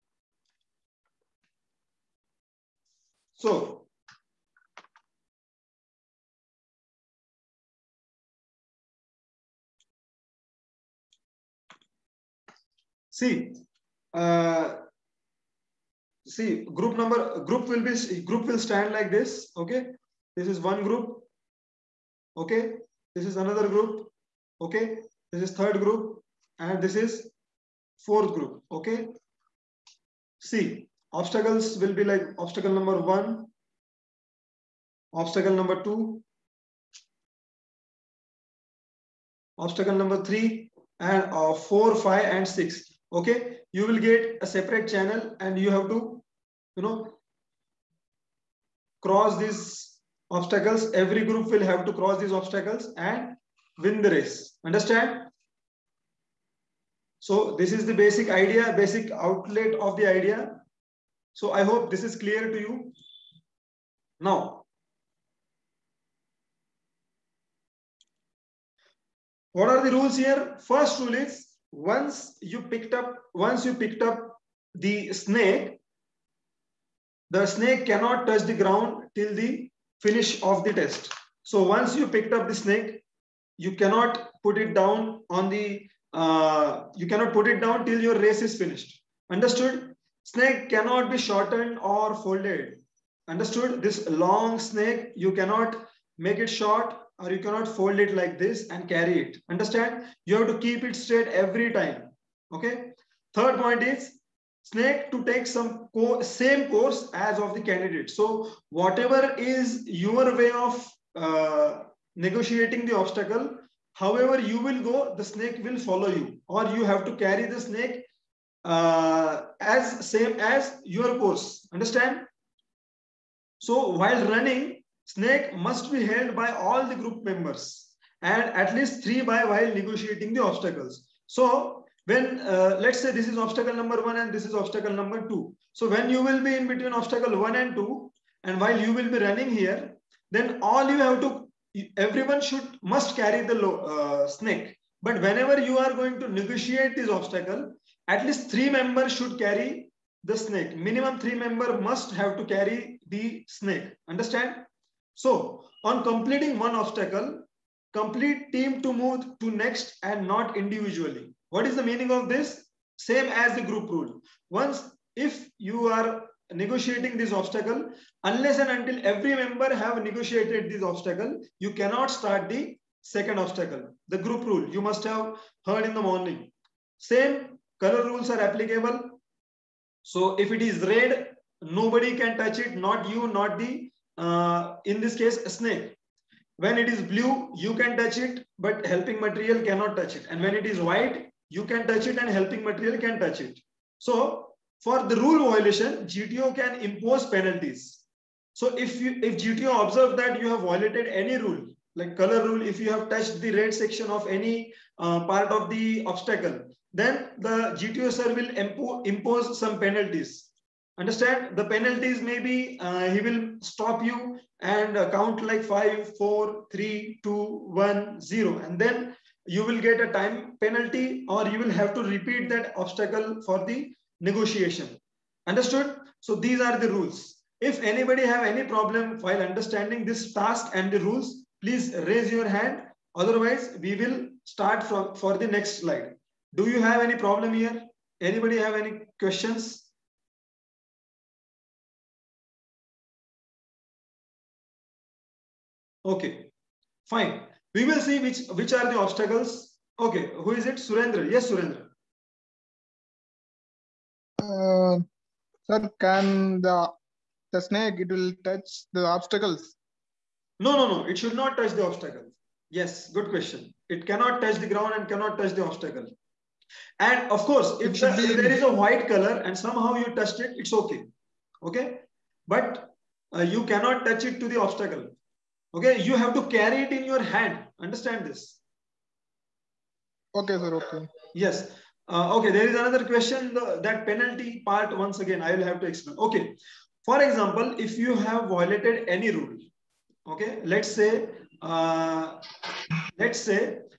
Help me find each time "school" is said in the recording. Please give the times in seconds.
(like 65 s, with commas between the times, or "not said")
not said.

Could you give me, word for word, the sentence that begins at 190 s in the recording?
And when it is white, you can touch it and helping material can touch it.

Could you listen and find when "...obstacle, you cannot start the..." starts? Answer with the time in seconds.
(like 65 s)
170 s.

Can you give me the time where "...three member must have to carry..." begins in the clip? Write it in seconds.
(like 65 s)
151 s.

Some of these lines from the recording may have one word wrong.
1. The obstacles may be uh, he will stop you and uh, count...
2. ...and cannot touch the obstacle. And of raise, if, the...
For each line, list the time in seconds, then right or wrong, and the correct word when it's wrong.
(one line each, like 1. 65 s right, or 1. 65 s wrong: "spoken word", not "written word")
1. 211 s wrong: "penalties", not "obstacles"
2. 264 s wrong: "course", not "raise".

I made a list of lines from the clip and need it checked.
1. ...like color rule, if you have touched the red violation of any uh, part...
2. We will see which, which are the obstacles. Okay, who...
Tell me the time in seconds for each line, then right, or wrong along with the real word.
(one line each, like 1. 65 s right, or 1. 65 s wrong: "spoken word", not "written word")
1. 201 s wrong: "section", not "violation"
2. 247 s right.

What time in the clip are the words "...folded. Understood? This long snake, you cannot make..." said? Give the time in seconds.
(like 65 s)
92 s.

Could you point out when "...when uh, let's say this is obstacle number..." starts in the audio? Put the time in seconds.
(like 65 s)
132 s.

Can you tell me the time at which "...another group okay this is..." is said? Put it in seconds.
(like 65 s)
23 s.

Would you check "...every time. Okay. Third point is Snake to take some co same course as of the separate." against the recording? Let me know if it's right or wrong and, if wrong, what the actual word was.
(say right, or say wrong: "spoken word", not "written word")
wrong: "candidate", not "separate".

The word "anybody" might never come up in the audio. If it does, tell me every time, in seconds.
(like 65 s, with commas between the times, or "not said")
227 s, 238 s.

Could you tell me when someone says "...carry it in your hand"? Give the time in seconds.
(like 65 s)
276 s.